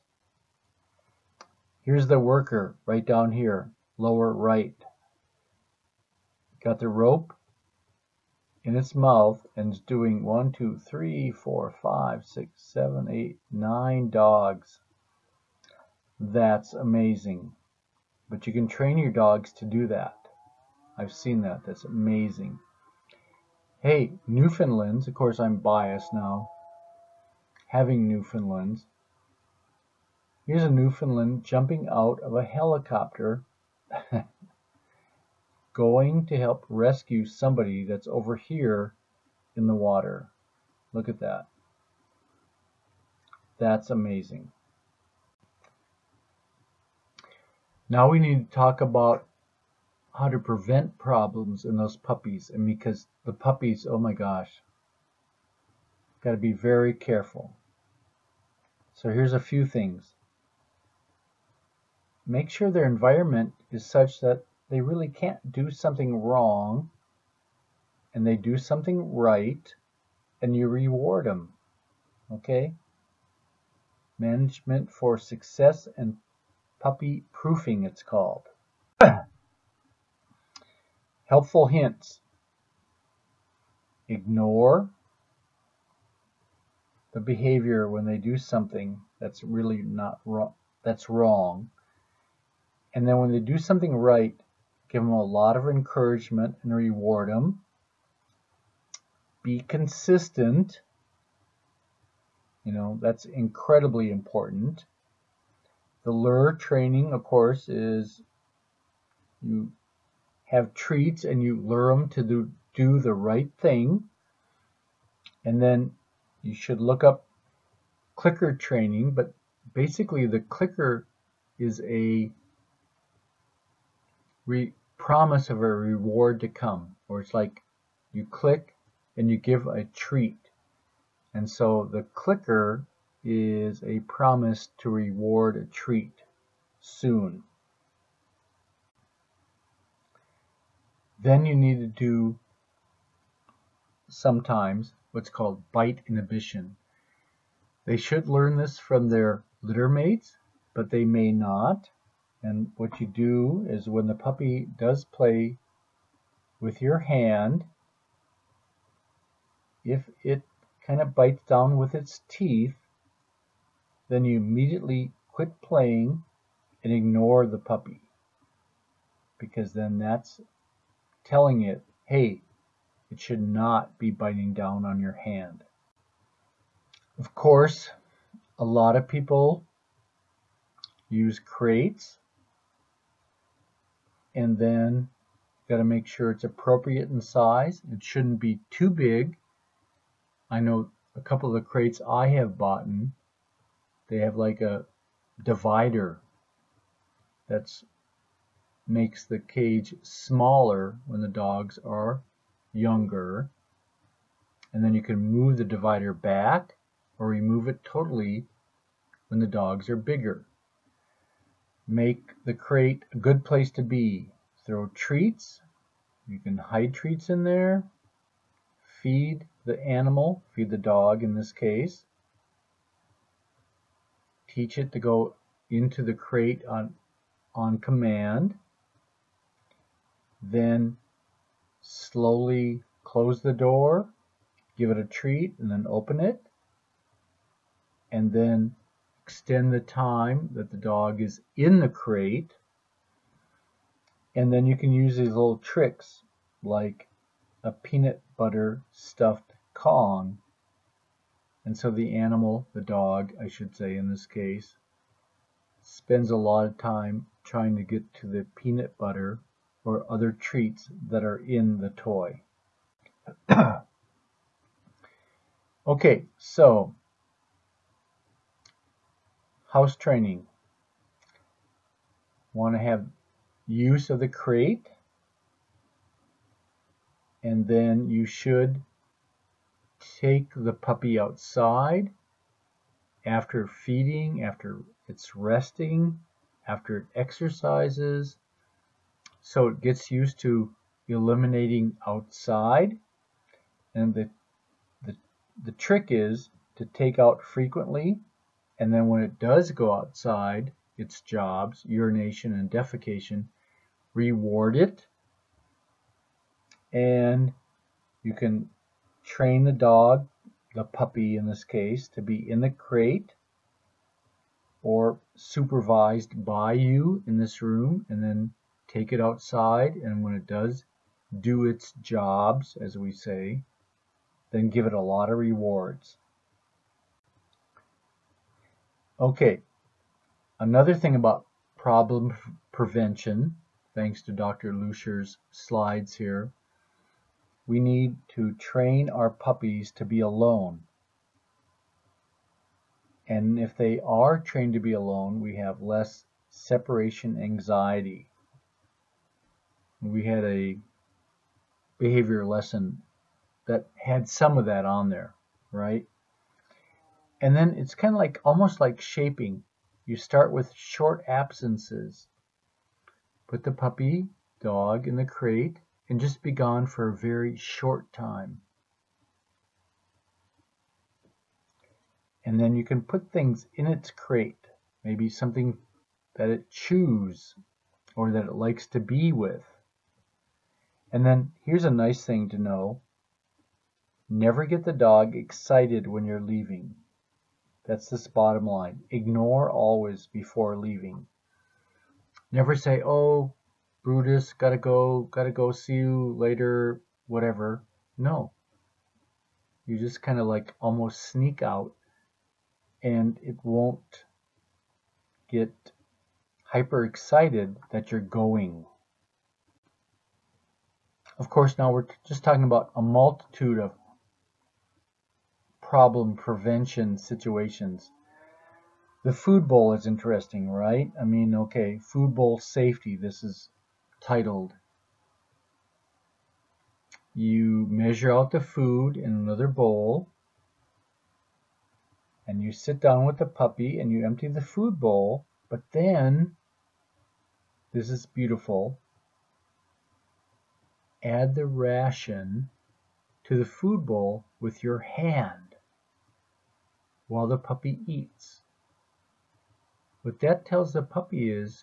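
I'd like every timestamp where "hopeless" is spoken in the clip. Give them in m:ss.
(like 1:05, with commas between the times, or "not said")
not said.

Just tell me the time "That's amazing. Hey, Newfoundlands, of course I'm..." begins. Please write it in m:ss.
0:21.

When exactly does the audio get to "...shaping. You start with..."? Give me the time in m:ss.
5:58.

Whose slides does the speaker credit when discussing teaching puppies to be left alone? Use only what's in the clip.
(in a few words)
Dr. Lusher.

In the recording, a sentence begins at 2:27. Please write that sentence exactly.
They should learn this from their litter mates, but they may not.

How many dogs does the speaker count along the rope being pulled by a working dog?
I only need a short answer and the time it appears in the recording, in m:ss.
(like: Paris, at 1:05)
9, at 0:13.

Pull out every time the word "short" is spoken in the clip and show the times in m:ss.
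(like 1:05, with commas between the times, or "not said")
6:00, 6:07.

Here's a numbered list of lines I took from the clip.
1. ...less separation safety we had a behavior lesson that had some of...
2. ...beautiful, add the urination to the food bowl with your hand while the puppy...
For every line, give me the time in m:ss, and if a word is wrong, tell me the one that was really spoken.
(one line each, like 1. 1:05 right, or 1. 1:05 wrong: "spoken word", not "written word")
1. 5:45 wrong: "anxiety", not "safety"
2. 7:18 wrong: "ration", not "urination".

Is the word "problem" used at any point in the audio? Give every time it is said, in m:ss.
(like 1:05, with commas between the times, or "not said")
0:50, 5:31, 6:55.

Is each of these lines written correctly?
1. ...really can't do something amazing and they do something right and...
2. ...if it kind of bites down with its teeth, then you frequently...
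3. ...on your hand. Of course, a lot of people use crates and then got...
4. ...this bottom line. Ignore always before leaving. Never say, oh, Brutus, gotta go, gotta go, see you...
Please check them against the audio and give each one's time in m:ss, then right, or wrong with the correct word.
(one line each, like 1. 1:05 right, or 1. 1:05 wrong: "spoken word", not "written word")
1. 1:04 wrong: "wrong", not "amazing"
2. 2:39 wrong: "immediately", not "frequently"
3. 2:54 right
4. 6:28 right.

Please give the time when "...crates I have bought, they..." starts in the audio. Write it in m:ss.
3:11.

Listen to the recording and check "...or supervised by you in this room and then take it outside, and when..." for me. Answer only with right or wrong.
right.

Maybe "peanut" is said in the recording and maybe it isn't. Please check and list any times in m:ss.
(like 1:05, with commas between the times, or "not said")
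4:07, 4:18.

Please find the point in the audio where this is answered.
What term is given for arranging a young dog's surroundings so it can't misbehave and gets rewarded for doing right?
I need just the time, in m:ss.
1:16.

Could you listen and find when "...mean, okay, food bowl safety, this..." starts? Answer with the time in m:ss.
7:01.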